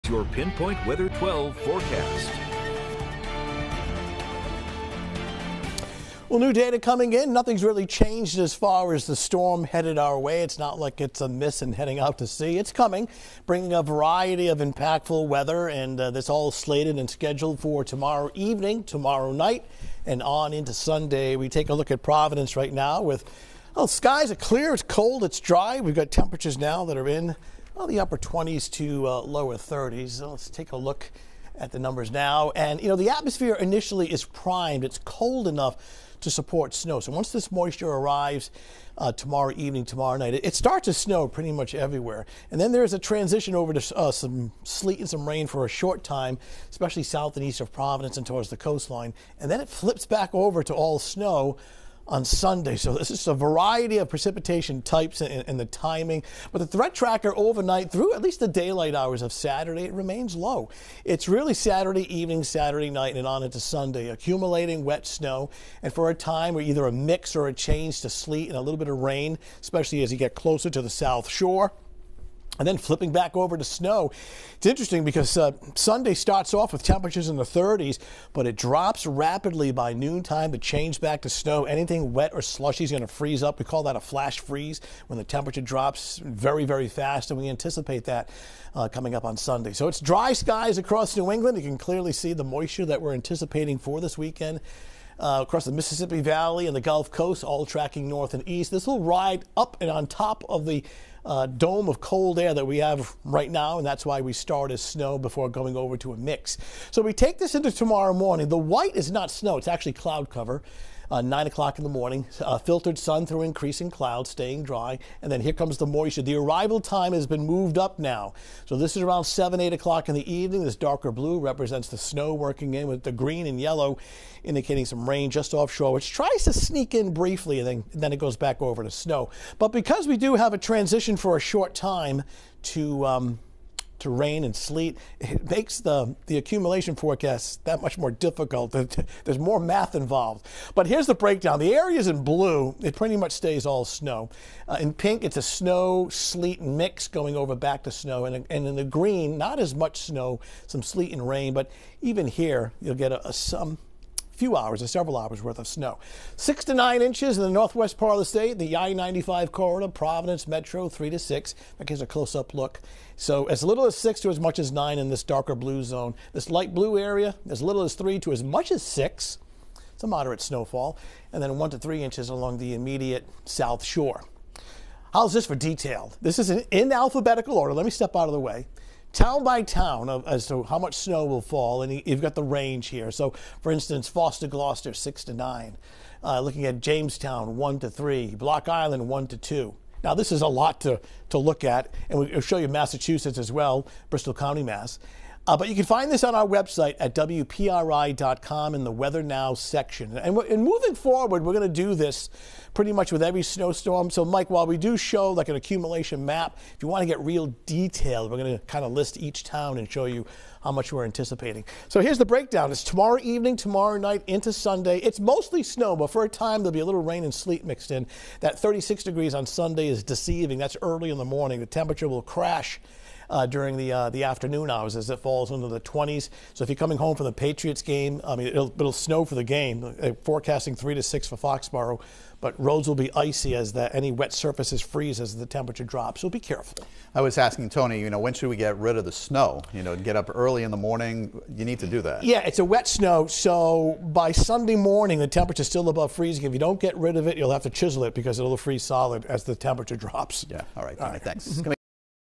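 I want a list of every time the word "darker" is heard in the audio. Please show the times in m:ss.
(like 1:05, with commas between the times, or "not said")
2:00, 2:45.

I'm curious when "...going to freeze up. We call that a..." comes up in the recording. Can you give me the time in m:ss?
1:22.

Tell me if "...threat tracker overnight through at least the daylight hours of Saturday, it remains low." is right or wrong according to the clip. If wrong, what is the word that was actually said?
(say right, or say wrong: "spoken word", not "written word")
right.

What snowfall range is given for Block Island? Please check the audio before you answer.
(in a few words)
1 to 2 inches.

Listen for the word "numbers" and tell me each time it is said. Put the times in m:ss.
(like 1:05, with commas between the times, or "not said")
0:31.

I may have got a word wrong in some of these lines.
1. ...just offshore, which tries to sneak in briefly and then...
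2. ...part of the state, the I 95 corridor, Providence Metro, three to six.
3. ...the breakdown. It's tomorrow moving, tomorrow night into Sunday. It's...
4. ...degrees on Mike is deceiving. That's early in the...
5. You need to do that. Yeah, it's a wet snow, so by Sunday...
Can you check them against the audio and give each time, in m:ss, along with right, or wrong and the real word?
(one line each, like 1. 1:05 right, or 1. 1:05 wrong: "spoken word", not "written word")
1. 2:05 right
2. 2:37 right
3. 3:32 wrong: "evening", not "moving"
4. 3:39 wrong: "Sunday", not "Mike"
5. 4:01 right.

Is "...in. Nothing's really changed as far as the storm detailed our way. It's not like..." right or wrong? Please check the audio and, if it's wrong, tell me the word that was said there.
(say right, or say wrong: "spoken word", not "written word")
wrong: "headed", not "detailed".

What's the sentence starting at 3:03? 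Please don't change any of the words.
So, for instance, Foster, Gloucester, six to nine.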